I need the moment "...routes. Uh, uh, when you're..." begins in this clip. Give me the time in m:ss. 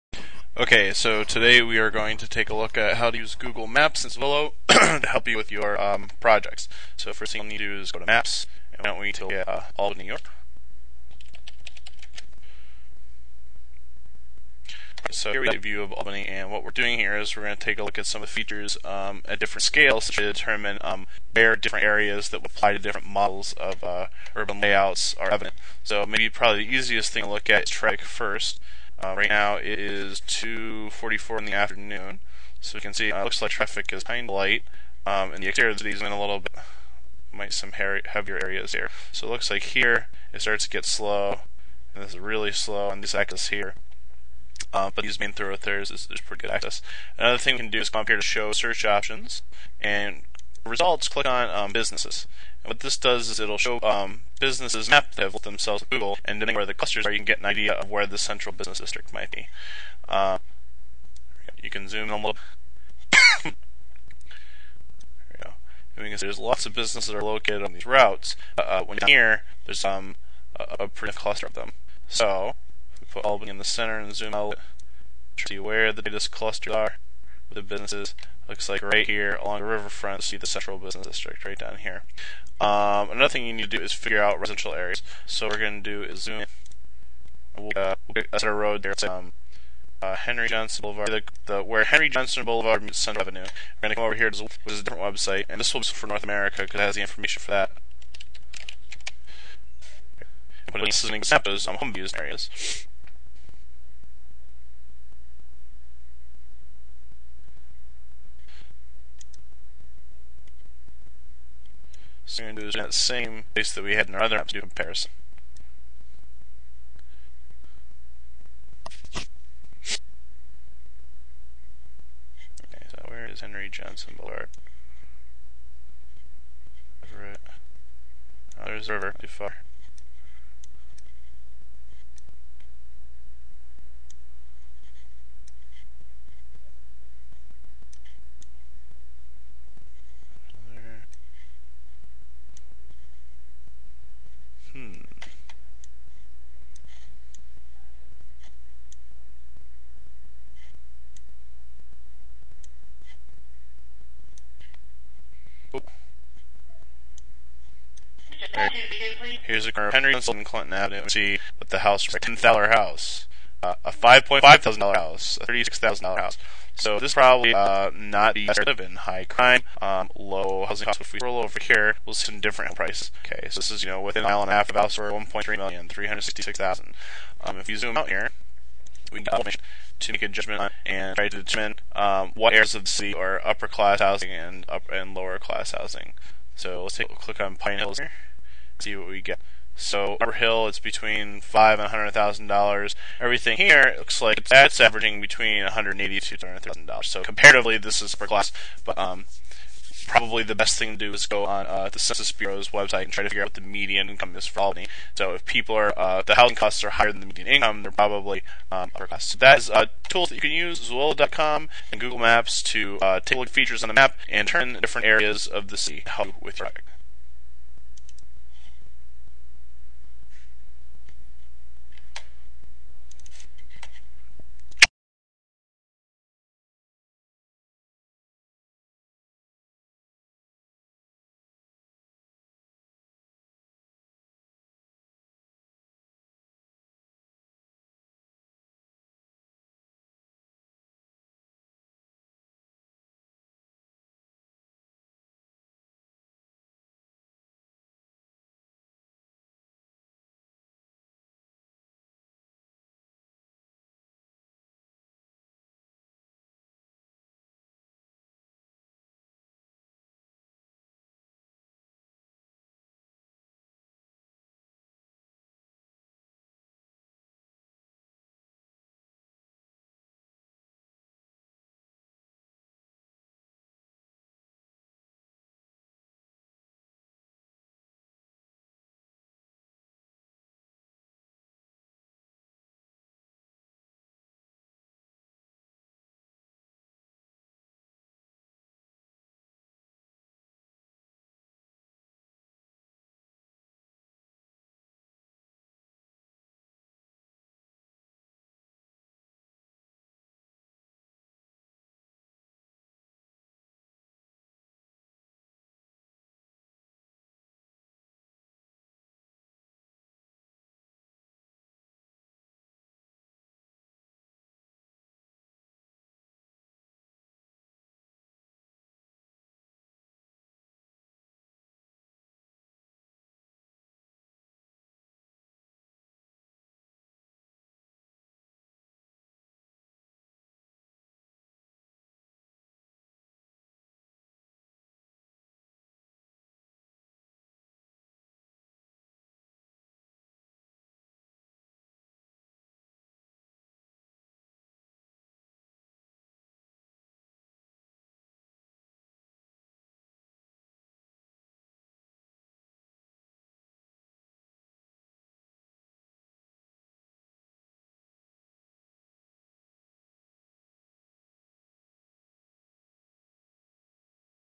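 1:07.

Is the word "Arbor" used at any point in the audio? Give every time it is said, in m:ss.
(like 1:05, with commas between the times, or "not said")
3:10.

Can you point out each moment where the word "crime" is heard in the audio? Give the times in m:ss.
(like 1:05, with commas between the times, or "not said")
2:49.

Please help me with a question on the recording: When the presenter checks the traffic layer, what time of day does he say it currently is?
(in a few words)
2:44 in the afternoon.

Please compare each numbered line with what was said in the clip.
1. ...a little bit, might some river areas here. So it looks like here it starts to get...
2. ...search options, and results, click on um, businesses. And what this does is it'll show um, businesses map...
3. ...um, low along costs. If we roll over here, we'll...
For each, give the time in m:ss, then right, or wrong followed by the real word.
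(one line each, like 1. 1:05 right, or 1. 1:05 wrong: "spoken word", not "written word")
1. 0:36 wrong: "heavier", not "river"
2. 0:48 right
3. 2:49 wrong: "housing", not "along".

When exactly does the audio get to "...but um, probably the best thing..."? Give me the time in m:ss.
3:18.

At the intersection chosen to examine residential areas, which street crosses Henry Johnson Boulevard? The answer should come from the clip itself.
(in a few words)
Central Avenue.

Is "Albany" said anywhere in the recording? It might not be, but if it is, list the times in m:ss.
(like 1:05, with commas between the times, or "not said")
0:15, 1:13, 3:24.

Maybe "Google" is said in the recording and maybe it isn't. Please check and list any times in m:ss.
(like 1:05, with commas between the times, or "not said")
0:03, 0:55, 3:32.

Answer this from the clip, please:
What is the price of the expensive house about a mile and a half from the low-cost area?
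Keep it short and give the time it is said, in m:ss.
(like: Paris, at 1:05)
1.3 million, at 2:55.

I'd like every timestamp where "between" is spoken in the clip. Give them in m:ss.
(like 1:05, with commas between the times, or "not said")
3:10, 3:15.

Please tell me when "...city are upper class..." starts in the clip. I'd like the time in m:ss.
3:02.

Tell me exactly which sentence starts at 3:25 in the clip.
So if people are, uh, the housing costs are higher than the median income, they're probably um, upper class.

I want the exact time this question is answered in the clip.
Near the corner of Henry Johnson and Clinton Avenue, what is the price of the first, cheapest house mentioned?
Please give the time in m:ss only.
2:42.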